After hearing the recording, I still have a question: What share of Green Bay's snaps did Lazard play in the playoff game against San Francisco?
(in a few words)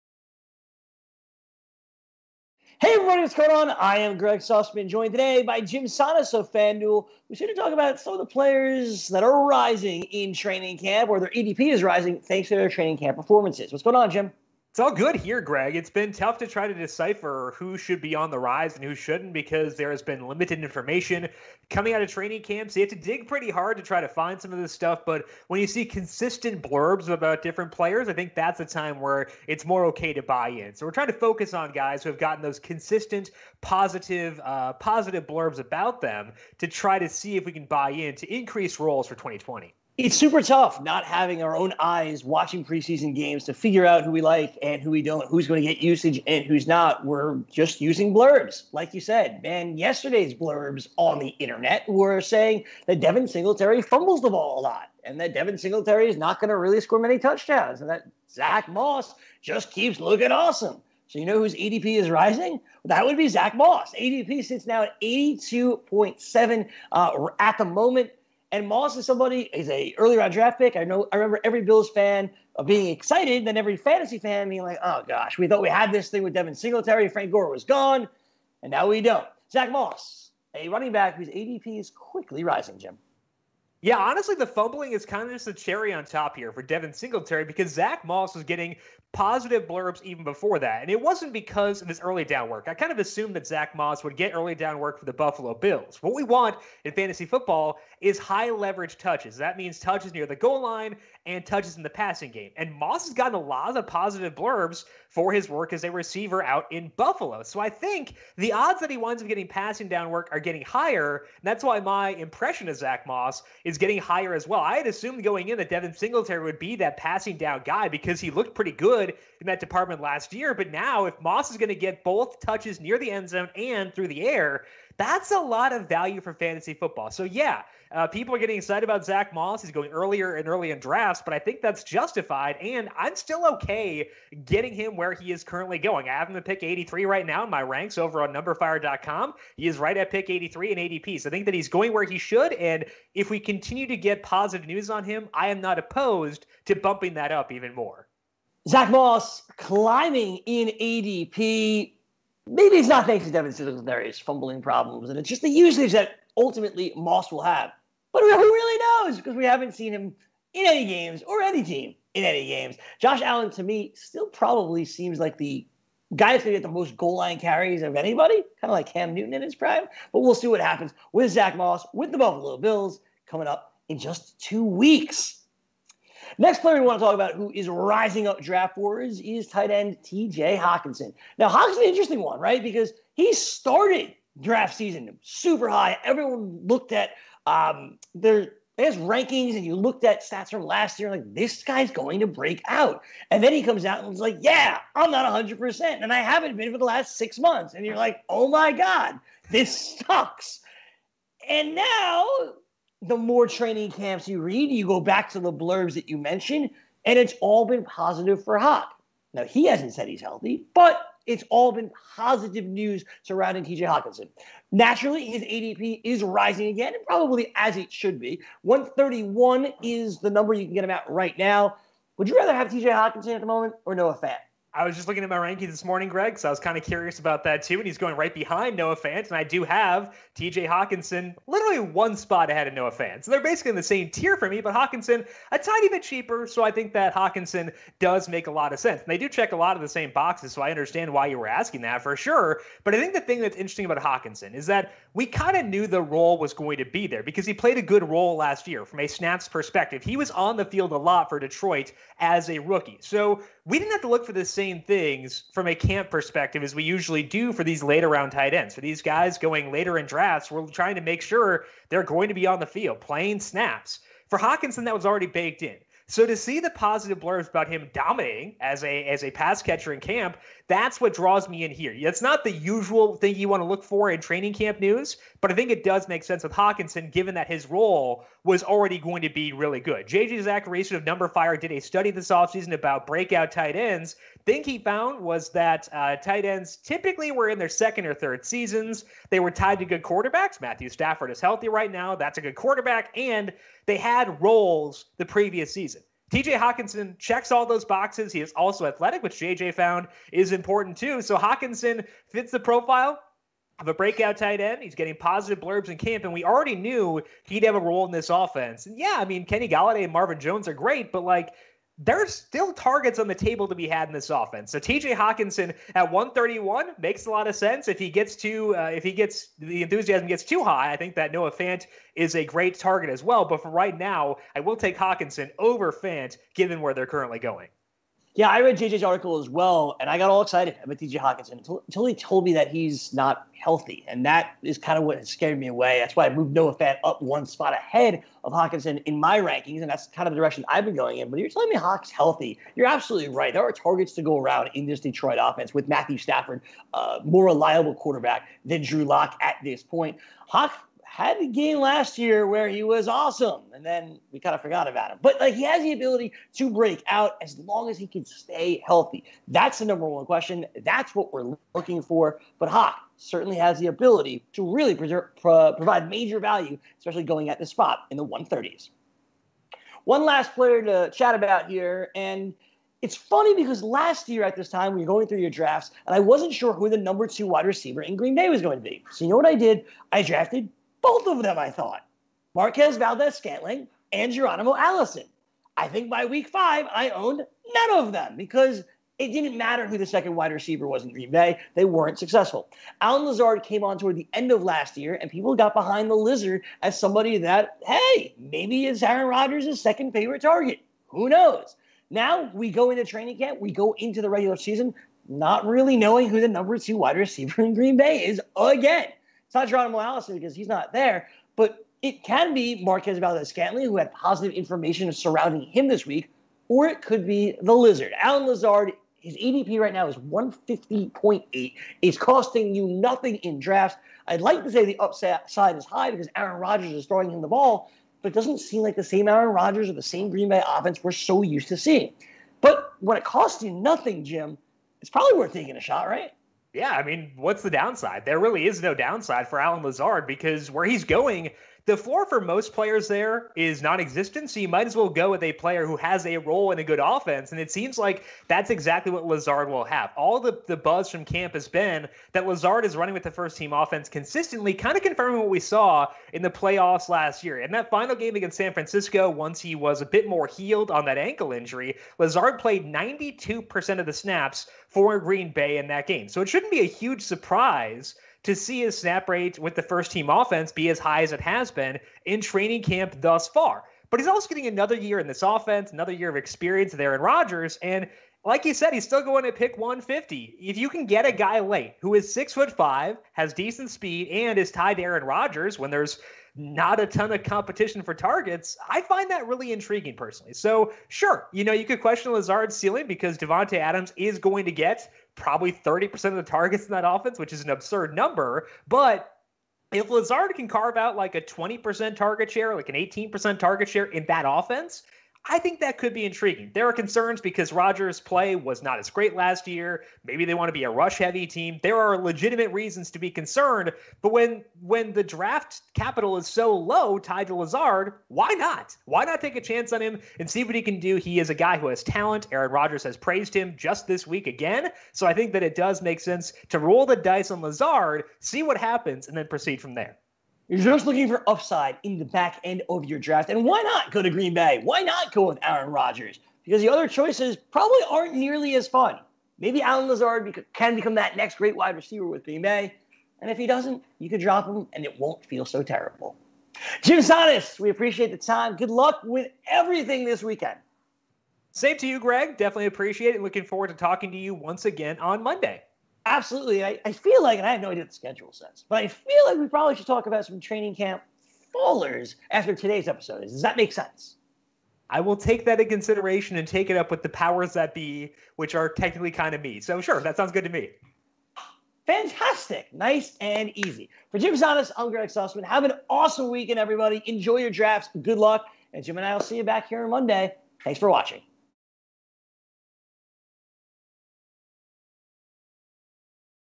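92%.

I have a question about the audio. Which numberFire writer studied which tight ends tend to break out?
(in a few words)
JJ Zachariason.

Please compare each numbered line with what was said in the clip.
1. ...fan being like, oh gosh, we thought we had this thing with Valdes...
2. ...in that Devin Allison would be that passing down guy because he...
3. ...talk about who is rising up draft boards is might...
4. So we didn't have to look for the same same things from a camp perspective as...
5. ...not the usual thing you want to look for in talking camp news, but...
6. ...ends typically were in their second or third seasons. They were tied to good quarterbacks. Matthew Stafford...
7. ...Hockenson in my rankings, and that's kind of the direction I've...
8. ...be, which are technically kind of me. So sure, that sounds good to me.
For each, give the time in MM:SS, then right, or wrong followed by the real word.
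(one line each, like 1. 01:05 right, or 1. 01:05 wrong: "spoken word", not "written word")
1. 01:14 wrong: "Devin", not "Valdes"
2. 01:55 wrong: "Singletary", not "Allison"
3. 02:57 wrong: "tight", not "might"
4. 04:13 right
5. 04:32 wrong: "training", not "talking"
6. 04:46 right
7. 05:38 right
8. 09:27 right.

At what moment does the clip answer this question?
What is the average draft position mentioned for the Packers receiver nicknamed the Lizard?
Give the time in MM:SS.
07:00.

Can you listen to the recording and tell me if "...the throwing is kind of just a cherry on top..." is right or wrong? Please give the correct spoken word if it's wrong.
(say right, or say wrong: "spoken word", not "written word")
wrong: "fumbling", not "throwing".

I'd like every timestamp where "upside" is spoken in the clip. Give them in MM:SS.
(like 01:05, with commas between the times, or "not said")
07:04, 08:51.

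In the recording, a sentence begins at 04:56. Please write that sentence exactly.
TJ Hockenson checks all those boxes.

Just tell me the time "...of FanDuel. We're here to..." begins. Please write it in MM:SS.
00:06.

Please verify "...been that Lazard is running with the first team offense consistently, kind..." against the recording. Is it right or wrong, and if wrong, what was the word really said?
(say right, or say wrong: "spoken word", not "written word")
right.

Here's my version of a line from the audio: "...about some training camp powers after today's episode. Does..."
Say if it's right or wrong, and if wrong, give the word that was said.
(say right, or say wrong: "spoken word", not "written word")
wrong: "fallers", not "powers".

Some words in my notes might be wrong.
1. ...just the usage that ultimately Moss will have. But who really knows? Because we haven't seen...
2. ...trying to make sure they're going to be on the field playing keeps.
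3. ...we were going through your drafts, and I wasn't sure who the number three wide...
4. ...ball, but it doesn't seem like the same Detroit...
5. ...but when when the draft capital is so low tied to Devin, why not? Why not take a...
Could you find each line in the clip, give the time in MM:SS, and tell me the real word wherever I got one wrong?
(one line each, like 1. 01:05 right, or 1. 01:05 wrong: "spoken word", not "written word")
1. 02:35 right
2. 04:20 wrong: "snaps", not "keeps"
3. 06:14 wrong: "two", not "three"
4. 07:07 wrong: "Aaron", not "Detroit"
5. 08:34 wrong: "Lazard", not "Devin".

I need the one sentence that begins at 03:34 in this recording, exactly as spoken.
Naturally, his ADP is rising again, and probably as it should be.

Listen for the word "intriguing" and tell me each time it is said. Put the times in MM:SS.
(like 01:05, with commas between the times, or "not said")
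08:09, 08:26.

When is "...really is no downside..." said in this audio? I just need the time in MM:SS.
07:18.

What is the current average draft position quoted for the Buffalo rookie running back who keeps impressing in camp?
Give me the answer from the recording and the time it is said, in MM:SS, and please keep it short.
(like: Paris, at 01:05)
82.7, at 01:05.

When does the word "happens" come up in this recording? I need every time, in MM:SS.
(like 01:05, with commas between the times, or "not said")
02:50, 08:48.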